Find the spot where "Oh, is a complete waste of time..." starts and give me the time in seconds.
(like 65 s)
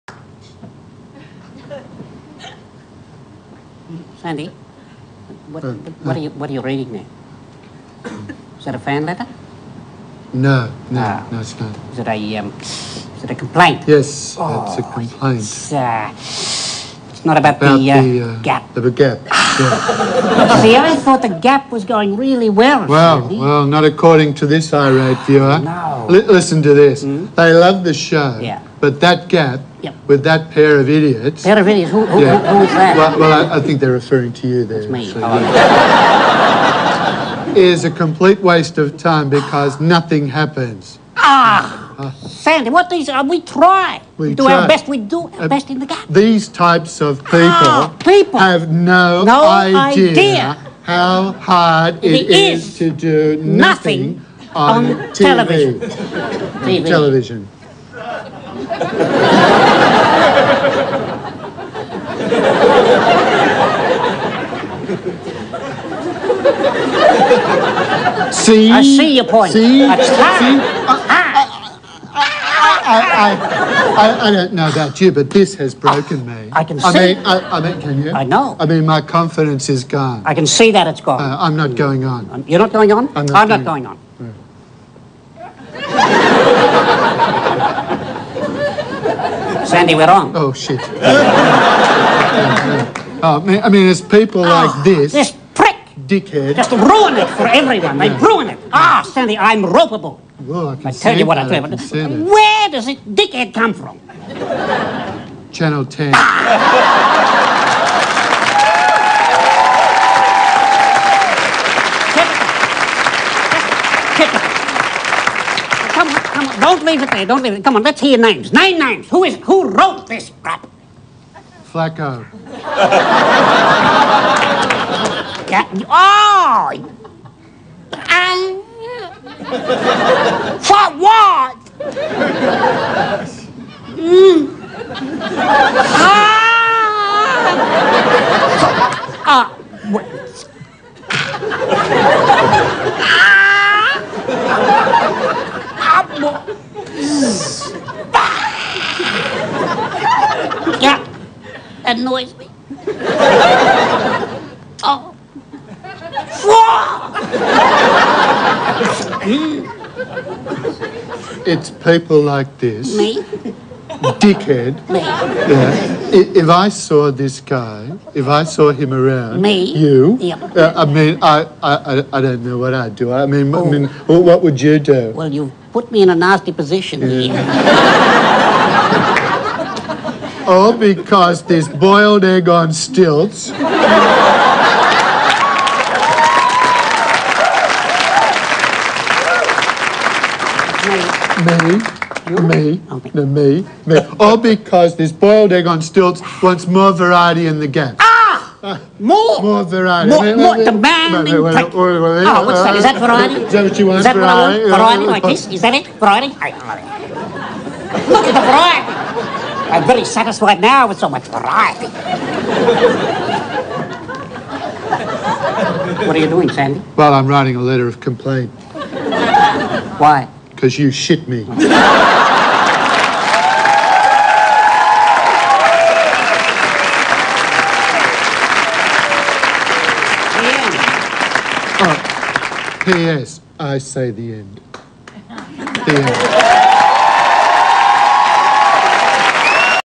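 37 s.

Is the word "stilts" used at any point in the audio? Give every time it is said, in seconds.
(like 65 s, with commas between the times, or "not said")
182 s, 195 s.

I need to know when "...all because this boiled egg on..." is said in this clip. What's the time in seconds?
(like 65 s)
194 s.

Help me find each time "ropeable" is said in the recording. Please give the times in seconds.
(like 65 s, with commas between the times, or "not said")
99 s.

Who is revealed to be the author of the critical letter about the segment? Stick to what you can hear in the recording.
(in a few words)
Flacco.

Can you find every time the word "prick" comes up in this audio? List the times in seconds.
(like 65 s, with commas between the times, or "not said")
95 s.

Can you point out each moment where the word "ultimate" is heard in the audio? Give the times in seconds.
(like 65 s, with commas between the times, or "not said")
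not said.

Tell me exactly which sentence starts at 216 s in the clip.
Well, I'm writing a letter of complaint.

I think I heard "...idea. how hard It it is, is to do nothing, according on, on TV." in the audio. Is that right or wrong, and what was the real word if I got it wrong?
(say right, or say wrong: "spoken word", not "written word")
wrong: "nothing", not "according".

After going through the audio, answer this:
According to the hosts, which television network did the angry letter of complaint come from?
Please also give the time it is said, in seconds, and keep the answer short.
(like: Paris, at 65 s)
Channel 10, at 105 s.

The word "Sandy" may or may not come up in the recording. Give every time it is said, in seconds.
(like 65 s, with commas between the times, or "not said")
4 s, 23 s, 42 s, 89 s, 99 s, 216 s.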